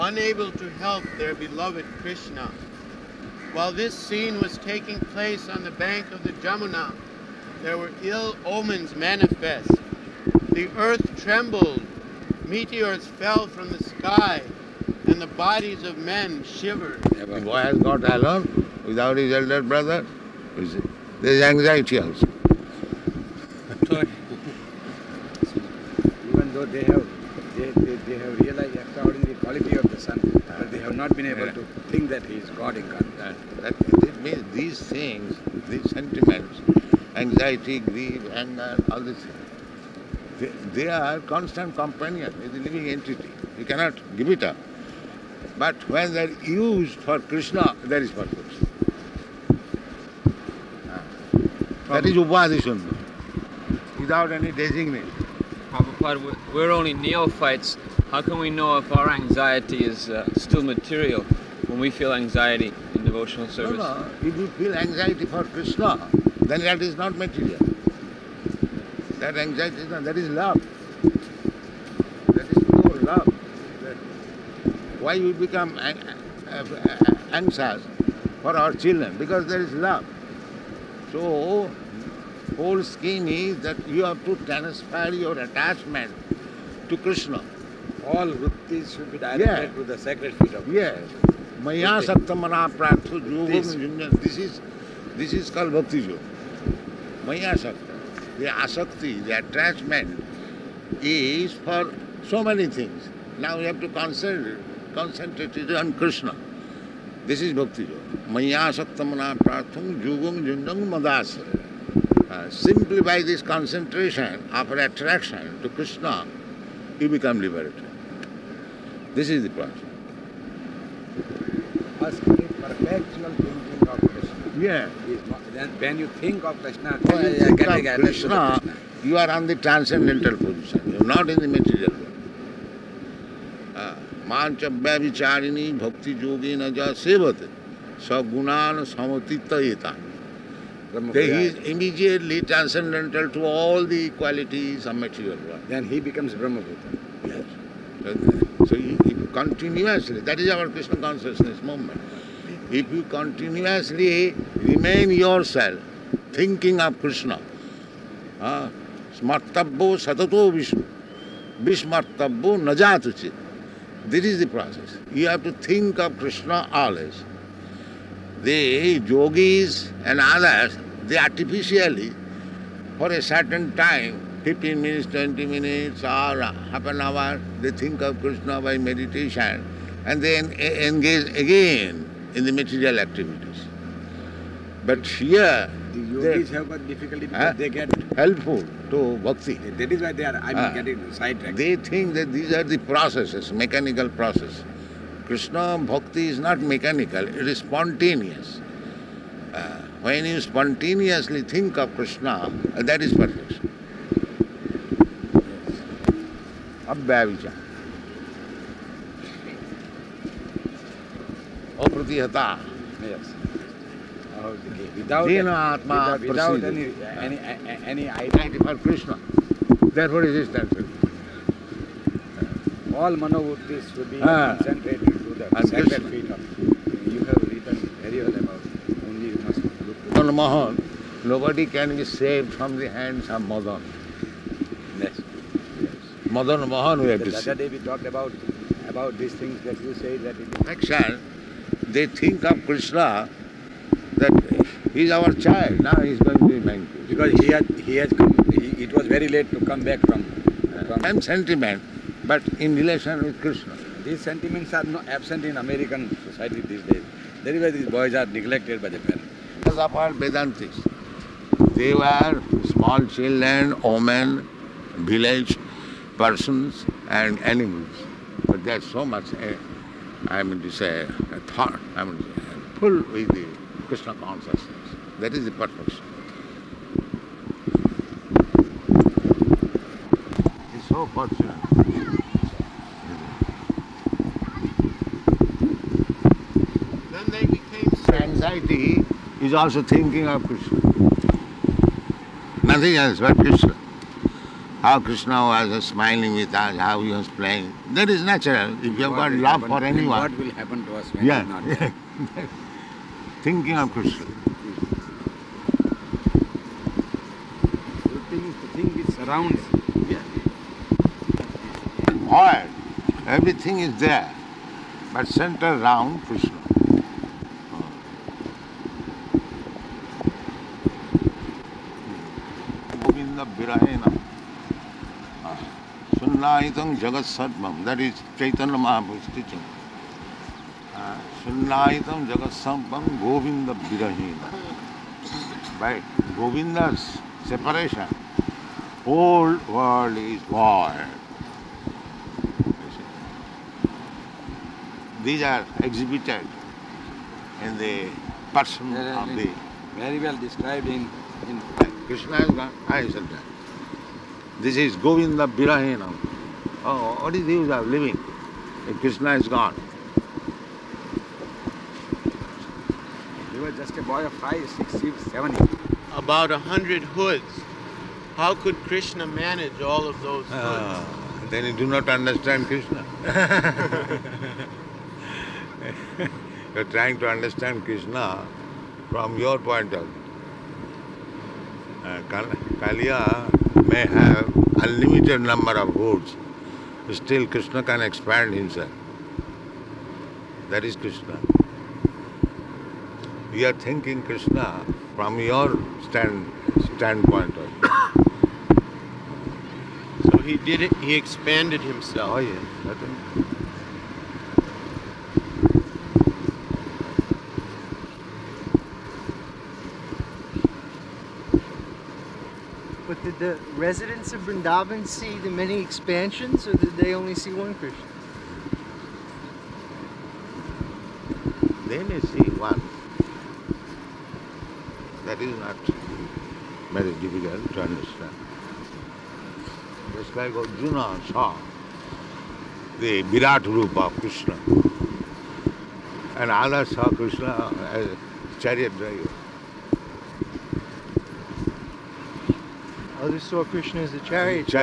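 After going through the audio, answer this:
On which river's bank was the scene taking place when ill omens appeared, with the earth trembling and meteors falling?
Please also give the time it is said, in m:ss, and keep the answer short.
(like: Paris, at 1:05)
Jamuna, at 0:06.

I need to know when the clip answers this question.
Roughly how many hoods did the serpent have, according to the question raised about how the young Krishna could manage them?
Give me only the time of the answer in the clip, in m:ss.
6:06.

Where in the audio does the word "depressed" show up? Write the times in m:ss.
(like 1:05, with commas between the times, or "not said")
not said.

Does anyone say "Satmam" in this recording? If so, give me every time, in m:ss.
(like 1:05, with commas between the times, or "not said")
5:27, 5:32.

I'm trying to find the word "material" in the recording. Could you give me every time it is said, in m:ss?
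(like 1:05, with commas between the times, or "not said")
1:00, 1:07, 2:11, 2:24, 3:02.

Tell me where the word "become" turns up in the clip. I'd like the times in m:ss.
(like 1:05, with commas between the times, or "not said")
1:15, 1:57, 2:25.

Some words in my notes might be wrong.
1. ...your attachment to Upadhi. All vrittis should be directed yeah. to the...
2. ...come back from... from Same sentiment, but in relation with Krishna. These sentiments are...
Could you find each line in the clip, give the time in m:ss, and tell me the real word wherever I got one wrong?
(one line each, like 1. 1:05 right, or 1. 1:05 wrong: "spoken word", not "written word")
1. 1:25 wrong: "Krishna", not "Upadhi"
2. 4:09 right.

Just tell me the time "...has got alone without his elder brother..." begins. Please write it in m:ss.
0:17.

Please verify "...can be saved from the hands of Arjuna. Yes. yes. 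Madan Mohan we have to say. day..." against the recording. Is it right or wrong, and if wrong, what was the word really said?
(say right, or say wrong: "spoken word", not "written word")
wrong: "Madan", not "Arjuna".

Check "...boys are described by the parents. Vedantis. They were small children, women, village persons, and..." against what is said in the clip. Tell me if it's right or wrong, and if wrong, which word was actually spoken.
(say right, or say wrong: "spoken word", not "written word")
wrong: "neglected", not "described".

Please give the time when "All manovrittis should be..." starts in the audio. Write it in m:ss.
3:42.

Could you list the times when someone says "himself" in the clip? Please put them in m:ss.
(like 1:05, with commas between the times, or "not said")
6:28, 6:41.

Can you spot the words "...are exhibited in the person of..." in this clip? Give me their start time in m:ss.
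5:45.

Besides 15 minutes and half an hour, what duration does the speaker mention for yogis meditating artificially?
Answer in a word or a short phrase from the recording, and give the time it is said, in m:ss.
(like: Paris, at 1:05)
20 minutes, at 2:55.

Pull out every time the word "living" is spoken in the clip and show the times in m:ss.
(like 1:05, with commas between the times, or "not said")
0:42, 5:57.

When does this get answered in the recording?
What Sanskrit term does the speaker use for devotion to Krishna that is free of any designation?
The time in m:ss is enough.
0:52.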